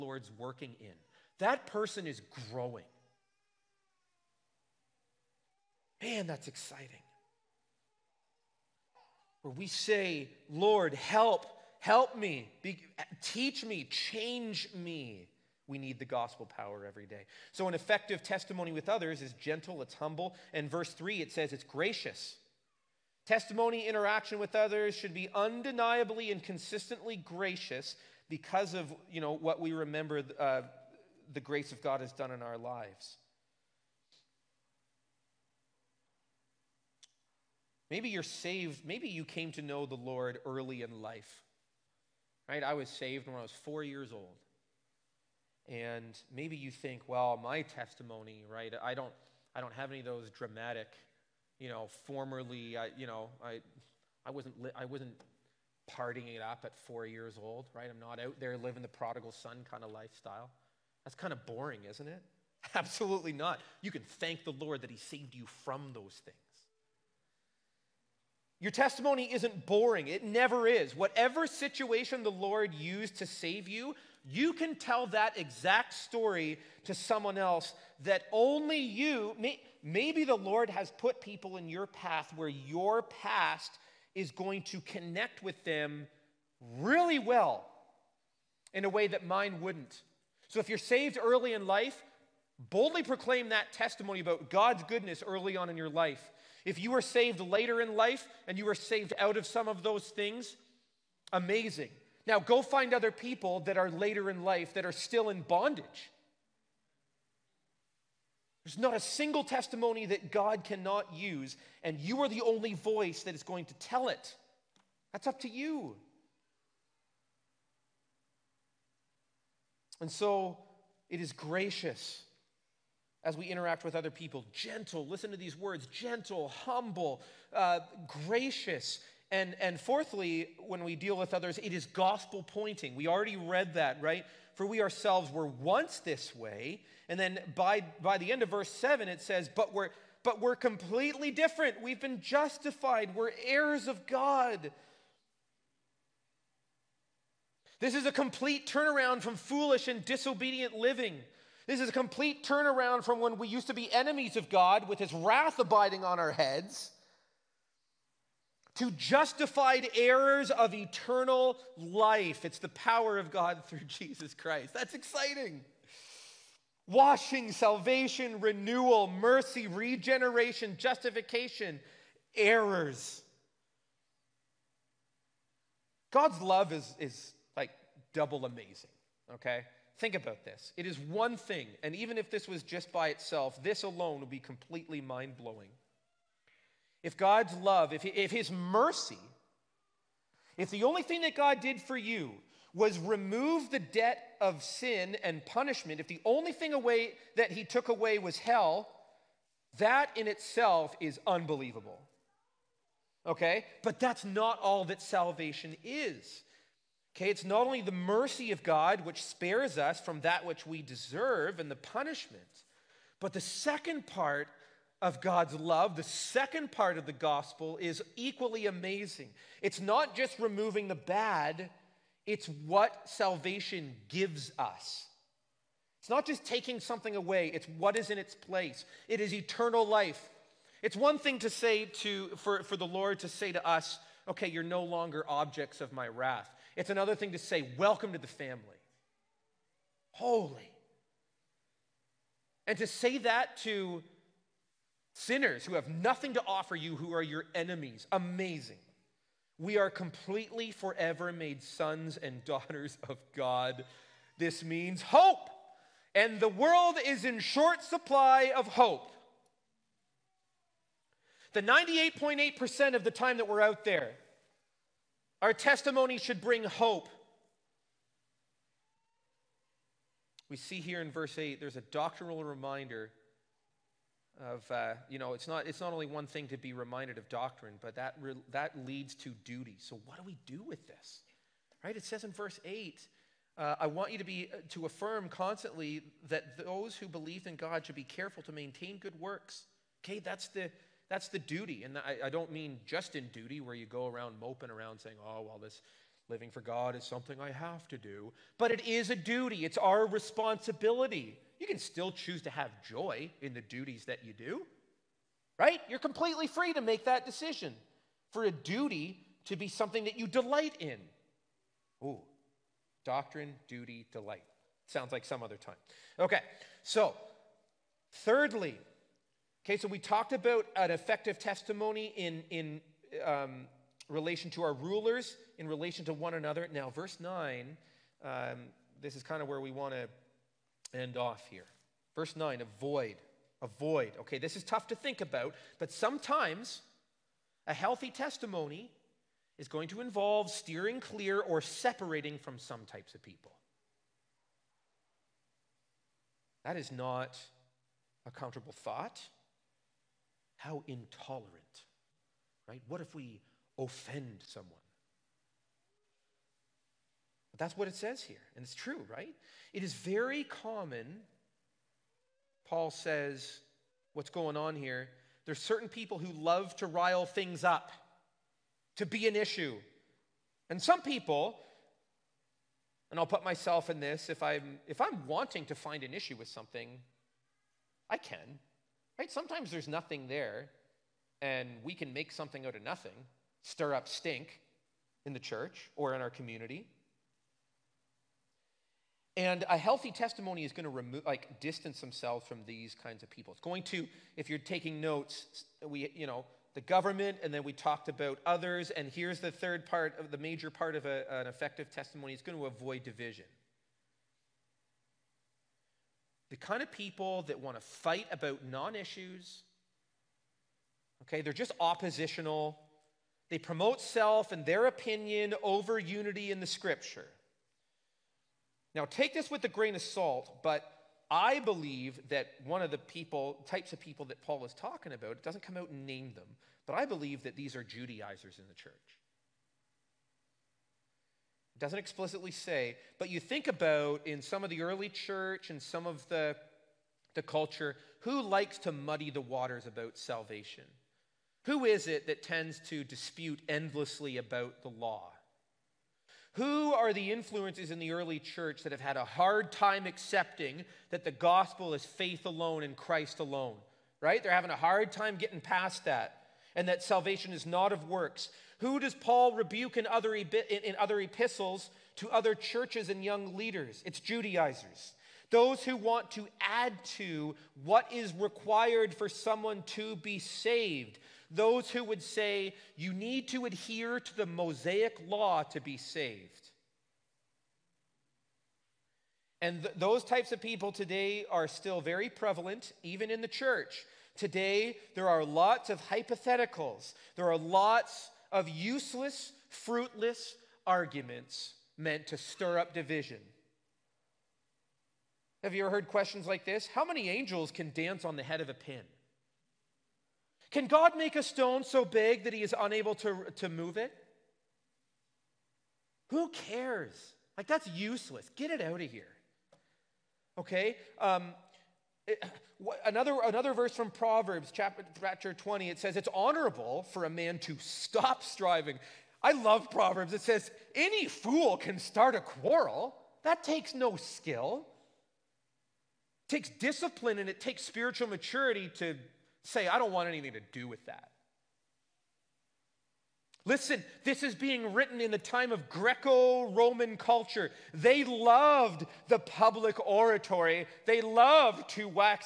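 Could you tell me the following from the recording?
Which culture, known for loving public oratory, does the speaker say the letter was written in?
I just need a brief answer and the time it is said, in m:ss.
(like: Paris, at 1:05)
Greco Roman culture, at 8:55.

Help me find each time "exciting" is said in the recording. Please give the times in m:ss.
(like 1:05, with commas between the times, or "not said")
0:06, 2:44.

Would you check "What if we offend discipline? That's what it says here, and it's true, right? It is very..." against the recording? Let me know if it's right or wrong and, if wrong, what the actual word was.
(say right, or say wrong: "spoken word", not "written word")
wrong: "someone", not "discipline".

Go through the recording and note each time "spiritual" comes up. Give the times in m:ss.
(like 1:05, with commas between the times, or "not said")
8:47.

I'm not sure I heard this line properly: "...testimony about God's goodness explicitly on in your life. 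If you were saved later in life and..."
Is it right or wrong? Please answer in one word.
wrong.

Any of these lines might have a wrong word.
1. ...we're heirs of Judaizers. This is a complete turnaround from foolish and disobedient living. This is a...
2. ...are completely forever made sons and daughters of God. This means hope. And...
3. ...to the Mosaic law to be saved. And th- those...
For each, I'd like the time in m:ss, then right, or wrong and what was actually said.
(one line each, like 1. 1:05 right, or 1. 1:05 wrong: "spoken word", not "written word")
1. 2:23 wrong: "God", not "Judaizers"
2. 4:09 right
3. 7:54 right.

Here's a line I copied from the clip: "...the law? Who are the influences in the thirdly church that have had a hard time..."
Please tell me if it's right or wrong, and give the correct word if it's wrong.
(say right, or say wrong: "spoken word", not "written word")
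wrong: "early", not "thirdly".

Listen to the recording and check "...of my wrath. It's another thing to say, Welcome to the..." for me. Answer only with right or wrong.
right.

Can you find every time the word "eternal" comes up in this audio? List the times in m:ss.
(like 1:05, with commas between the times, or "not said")
2:40, 3:49.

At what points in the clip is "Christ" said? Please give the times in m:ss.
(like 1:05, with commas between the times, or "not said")
2:44, 7:32.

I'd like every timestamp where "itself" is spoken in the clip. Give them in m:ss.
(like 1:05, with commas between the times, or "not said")
3:03, 3:20.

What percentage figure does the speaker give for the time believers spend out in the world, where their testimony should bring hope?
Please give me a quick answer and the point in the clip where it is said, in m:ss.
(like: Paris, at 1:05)
98.8%, at 4:21.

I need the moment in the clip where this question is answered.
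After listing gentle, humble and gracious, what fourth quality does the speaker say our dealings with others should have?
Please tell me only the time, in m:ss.
2:11.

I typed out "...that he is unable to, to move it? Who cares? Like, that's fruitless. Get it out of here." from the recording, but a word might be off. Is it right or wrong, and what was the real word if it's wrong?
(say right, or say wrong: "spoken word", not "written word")
wrong: "useless", not "fruitless".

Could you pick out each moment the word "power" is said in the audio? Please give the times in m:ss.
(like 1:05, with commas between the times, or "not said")
0:16, 2:42.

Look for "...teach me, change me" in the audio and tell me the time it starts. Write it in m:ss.
0:13.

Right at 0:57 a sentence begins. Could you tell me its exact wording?
I'm not out there living the prodigal son kind of lifestyle.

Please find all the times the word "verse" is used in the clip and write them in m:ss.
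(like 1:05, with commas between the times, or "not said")
0:20, 2:18, 4:31, 4:42, 5:26, 5:32, 8:33.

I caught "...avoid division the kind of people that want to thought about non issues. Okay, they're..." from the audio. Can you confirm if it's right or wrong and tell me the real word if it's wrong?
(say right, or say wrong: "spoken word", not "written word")
wrong: "fight", not "thought".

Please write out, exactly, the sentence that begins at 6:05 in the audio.
There's certain people who love to rile things up, to be an issue.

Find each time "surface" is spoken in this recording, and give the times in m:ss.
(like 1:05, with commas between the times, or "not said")
not said.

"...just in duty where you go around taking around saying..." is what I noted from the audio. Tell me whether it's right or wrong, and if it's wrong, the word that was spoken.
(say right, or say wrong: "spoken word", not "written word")
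wrong: "moping", not "taking".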